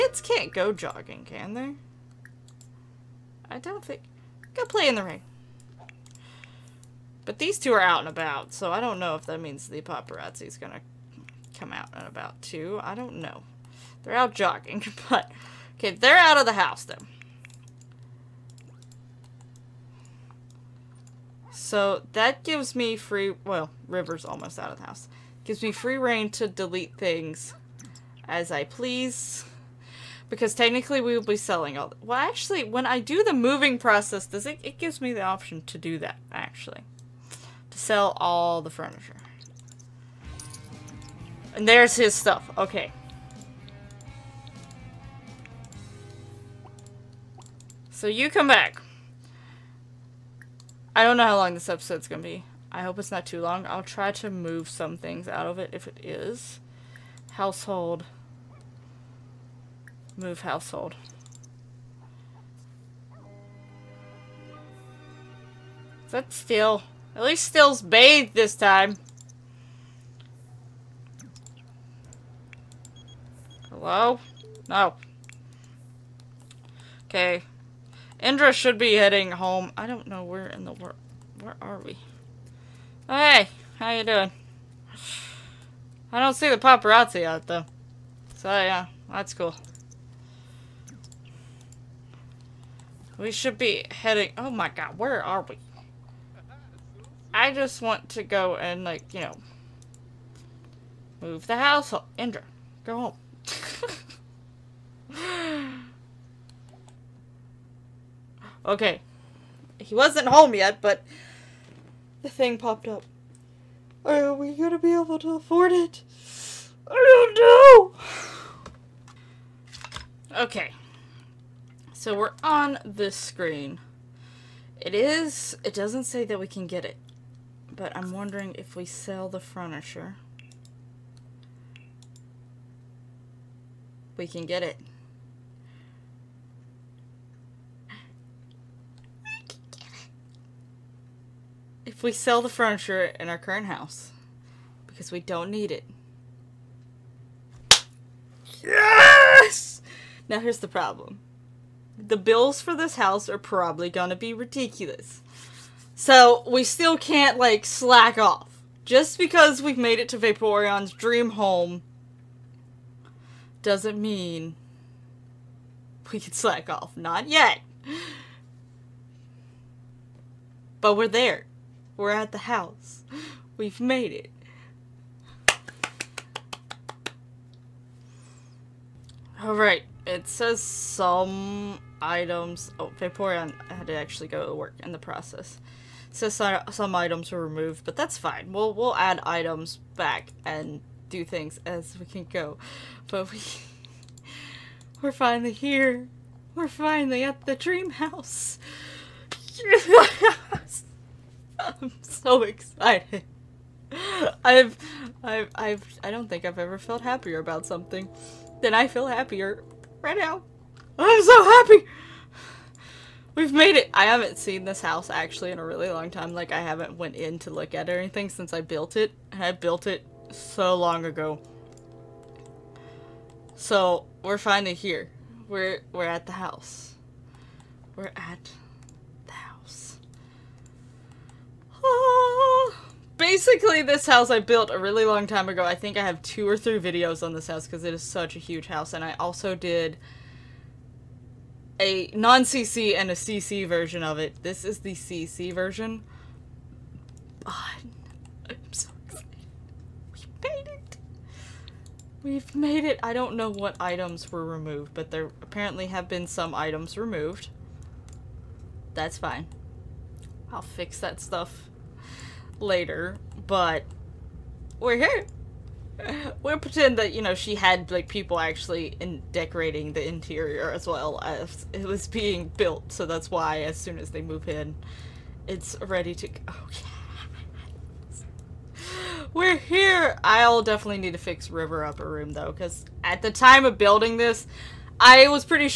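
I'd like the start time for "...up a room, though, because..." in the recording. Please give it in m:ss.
4:41.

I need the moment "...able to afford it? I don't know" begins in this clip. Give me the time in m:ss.
1:54.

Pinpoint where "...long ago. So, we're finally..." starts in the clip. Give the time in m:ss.
3:40.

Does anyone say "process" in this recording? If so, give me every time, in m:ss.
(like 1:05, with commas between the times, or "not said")
0:33, 3:04.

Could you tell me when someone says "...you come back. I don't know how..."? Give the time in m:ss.
0:48.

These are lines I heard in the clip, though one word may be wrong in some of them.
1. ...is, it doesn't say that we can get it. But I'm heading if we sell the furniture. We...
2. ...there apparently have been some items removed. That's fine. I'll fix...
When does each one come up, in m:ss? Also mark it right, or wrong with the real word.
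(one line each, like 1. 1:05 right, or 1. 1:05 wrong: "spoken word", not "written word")
1. 2:04 wrong: "wondering", not "heading"
2. 4:15 right.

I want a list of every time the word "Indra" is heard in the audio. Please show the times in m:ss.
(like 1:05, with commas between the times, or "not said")
1:18, 1:42.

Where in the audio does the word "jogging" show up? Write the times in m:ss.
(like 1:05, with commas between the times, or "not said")
0:00, 0:14.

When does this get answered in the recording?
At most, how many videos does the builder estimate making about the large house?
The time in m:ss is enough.
3:56.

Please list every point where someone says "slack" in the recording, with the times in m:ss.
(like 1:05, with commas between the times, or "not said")
2:37, 2:46.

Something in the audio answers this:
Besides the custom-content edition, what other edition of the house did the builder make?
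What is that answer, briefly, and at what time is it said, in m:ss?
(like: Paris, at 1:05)
non-CC, at 4:02.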